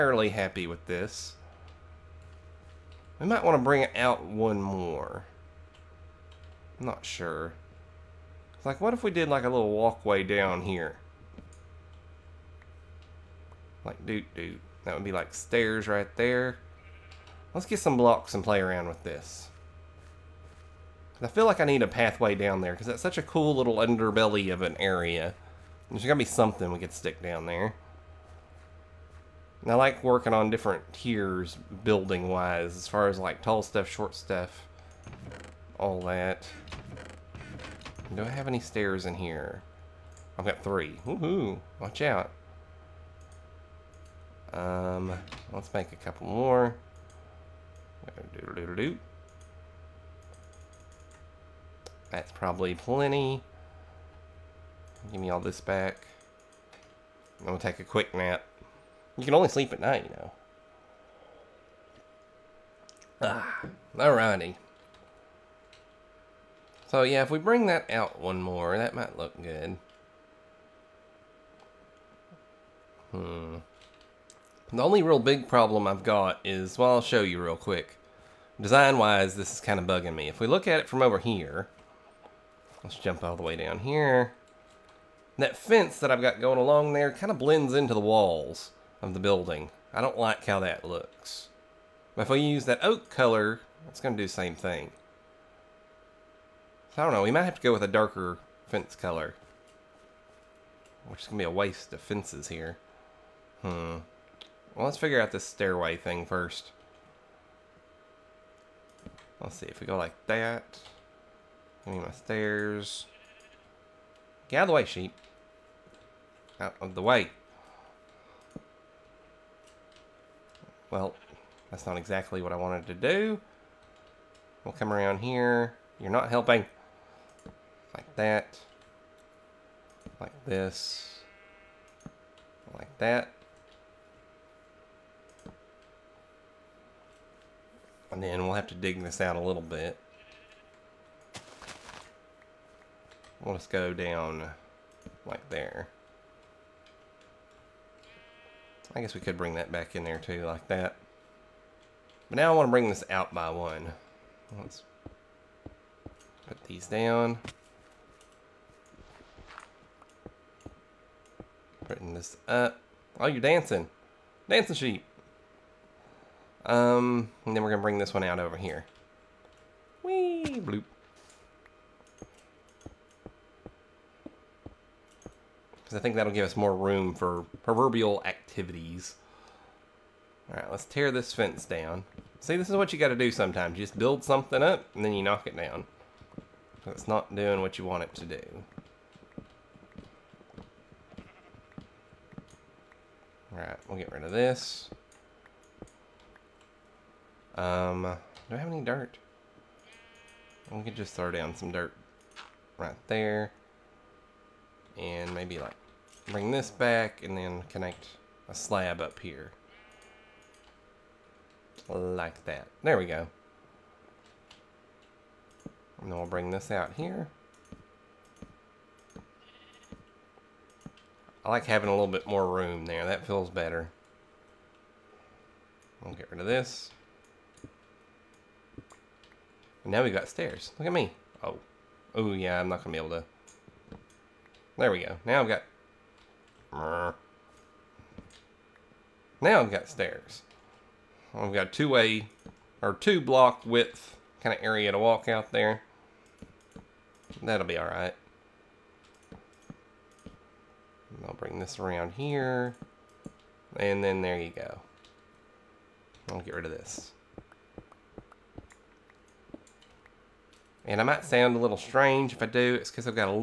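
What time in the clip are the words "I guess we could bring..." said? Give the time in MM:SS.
02:28.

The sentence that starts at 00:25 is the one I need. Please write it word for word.
There's gotta be something we could stick down there.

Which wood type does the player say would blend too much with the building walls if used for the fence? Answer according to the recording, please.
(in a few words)
oak.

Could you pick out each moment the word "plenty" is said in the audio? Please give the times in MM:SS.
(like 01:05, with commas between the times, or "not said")
00:52.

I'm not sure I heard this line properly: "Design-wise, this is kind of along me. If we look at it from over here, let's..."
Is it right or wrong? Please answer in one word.
wrong.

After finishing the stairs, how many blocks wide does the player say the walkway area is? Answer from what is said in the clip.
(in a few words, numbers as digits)
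2.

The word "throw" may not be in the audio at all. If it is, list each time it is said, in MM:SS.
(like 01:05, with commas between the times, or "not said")
03:21.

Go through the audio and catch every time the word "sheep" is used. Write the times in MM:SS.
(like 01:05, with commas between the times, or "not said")
01:54, 02:44.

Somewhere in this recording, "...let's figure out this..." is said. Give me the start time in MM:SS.
01:44.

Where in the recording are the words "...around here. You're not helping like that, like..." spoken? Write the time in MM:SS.
02:04.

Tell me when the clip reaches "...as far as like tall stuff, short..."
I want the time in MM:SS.
00:32.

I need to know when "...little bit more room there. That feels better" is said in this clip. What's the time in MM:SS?
03:41.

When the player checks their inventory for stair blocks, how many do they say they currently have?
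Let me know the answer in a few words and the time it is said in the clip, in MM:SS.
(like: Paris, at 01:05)
3, at 00:40.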